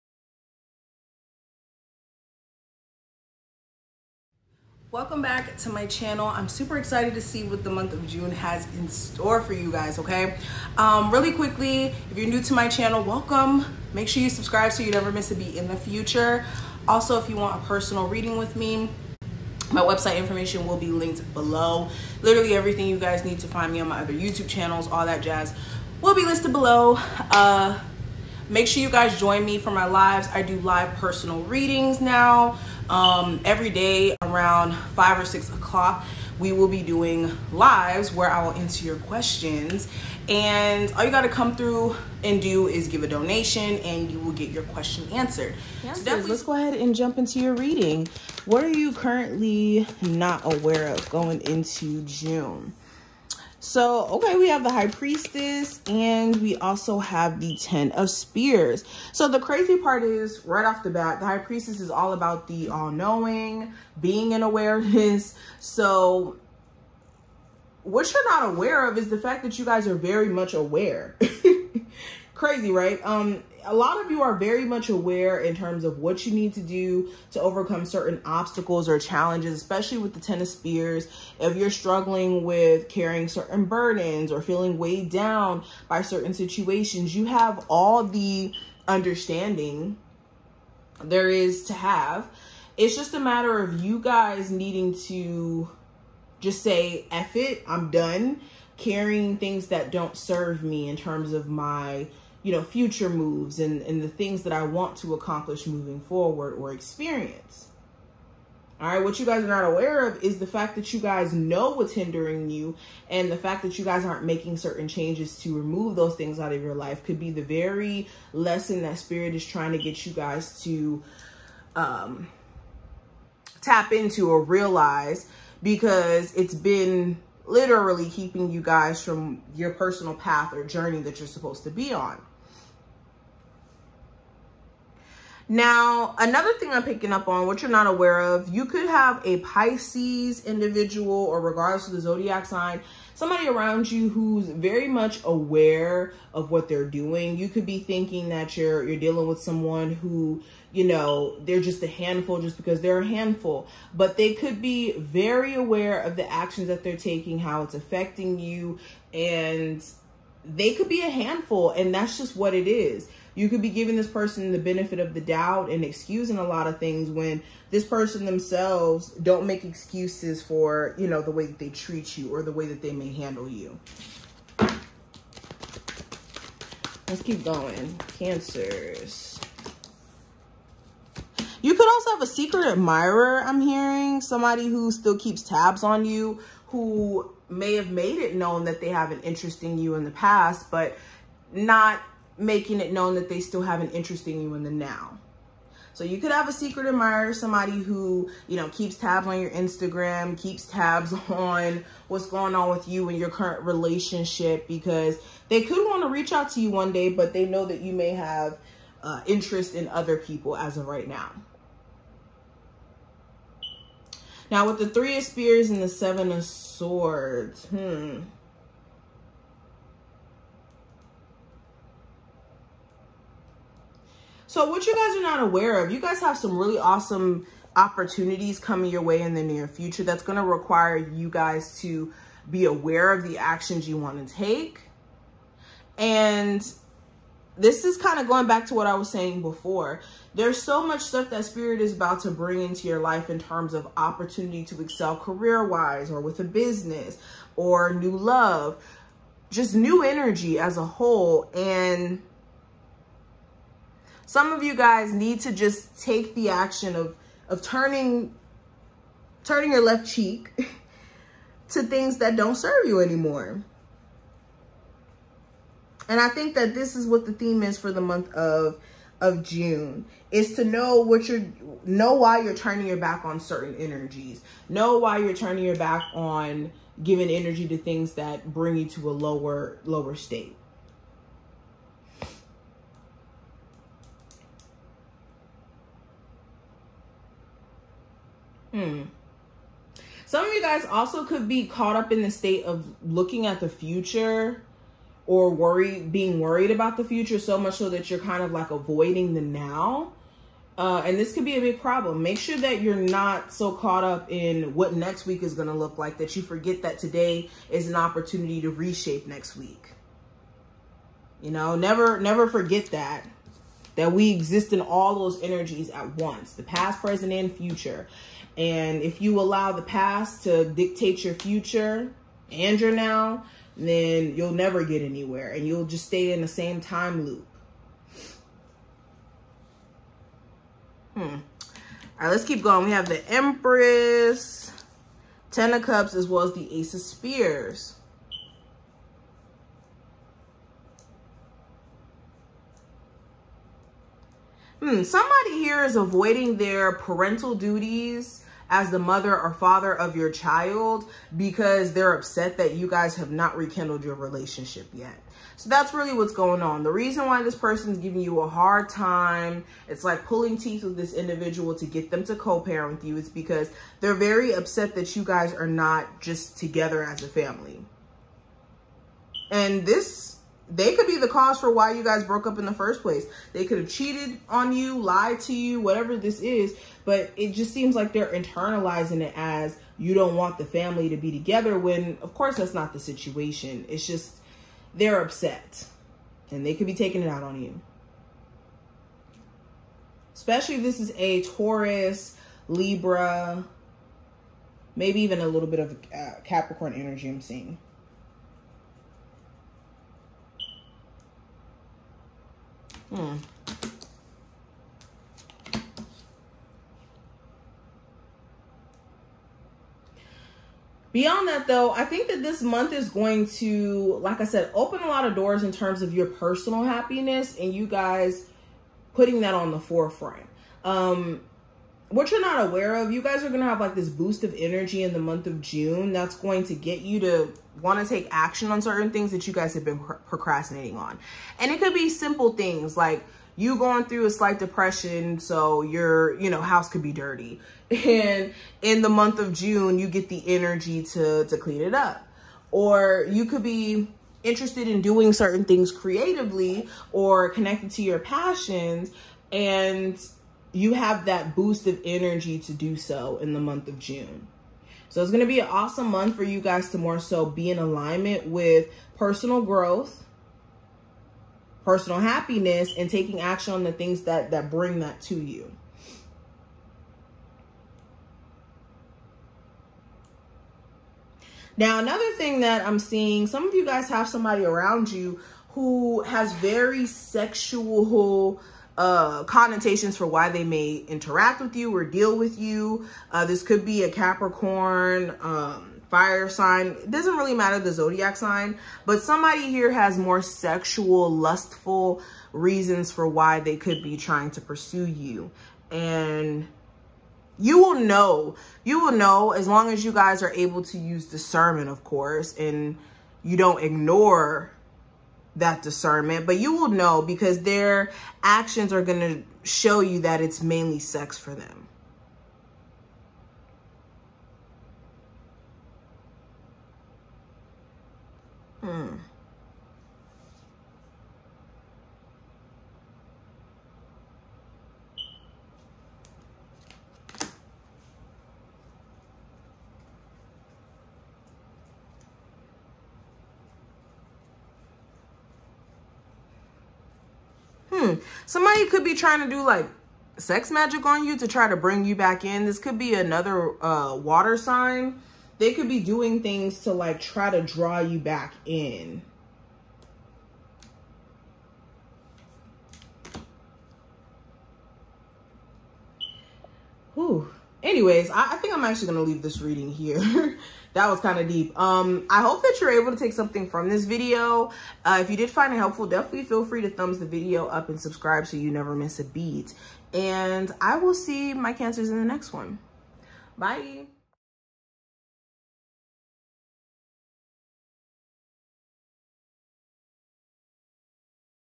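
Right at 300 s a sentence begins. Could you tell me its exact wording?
Uh, and this could be a big problem.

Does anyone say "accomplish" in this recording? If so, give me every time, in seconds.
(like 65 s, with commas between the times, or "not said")
105 s.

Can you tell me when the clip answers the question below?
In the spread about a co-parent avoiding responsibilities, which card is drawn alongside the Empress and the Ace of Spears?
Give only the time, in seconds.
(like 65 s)
335 s.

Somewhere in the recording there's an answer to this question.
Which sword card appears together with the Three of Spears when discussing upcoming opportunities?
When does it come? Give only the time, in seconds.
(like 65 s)
215 s.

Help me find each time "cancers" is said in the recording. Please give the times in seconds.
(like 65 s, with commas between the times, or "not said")
178 s, 571 s.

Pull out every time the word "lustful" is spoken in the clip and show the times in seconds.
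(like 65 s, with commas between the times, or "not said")
491 s.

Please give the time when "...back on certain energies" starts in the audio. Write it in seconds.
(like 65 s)
272 s.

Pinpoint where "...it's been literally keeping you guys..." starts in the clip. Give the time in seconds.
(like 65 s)
126 s.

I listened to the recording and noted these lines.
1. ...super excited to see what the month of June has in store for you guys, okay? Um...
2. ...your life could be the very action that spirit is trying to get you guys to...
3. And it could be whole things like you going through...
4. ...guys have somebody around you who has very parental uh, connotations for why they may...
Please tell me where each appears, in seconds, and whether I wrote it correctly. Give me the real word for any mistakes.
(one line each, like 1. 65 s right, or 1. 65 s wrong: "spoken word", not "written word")
1. 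6 s right
2. 116 s wrong: "lesson", not "action"
3. 431 s wrong: "simple", not "whole"
4. 473 s wrong: "sexual", not "parental".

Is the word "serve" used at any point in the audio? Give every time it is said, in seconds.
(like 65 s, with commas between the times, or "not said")
100 s, 262 s.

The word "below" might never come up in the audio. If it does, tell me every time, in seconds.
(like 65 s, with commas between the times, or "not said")
21 s, 26 s.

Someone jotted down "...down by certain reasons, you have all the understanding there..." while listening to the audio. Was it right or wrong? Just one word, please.
wrong.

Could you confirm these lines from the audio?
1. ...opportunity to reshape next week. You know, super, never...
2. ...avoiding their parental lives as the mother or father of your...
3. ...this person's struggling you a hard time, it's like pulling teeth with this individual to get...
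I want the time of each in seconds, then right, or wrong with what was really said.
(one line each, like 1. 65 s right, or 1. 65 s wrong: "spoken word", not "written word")
1. 307 s wrong: "never", not "super"
2. 345 s wrong: "duties", not "lives"
3. 357 s wrong: "giving", not "struggling".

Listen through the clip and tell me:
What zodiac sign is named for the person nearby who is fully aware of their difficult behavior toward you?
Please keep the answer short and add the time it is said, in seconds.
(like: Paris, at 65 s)
Pisces, at 139 s.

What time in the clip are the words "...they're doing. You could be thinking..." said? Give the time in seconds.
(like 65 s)
146 s.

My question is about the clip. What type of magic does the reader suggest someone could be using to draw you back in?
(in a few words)
Sex magic.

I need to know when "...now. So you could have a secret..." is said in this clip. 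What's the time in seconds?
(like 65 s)
194 s.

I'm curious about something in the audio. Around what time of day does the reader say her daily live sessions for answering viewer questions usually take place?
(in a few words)
5 or 6 o'clock.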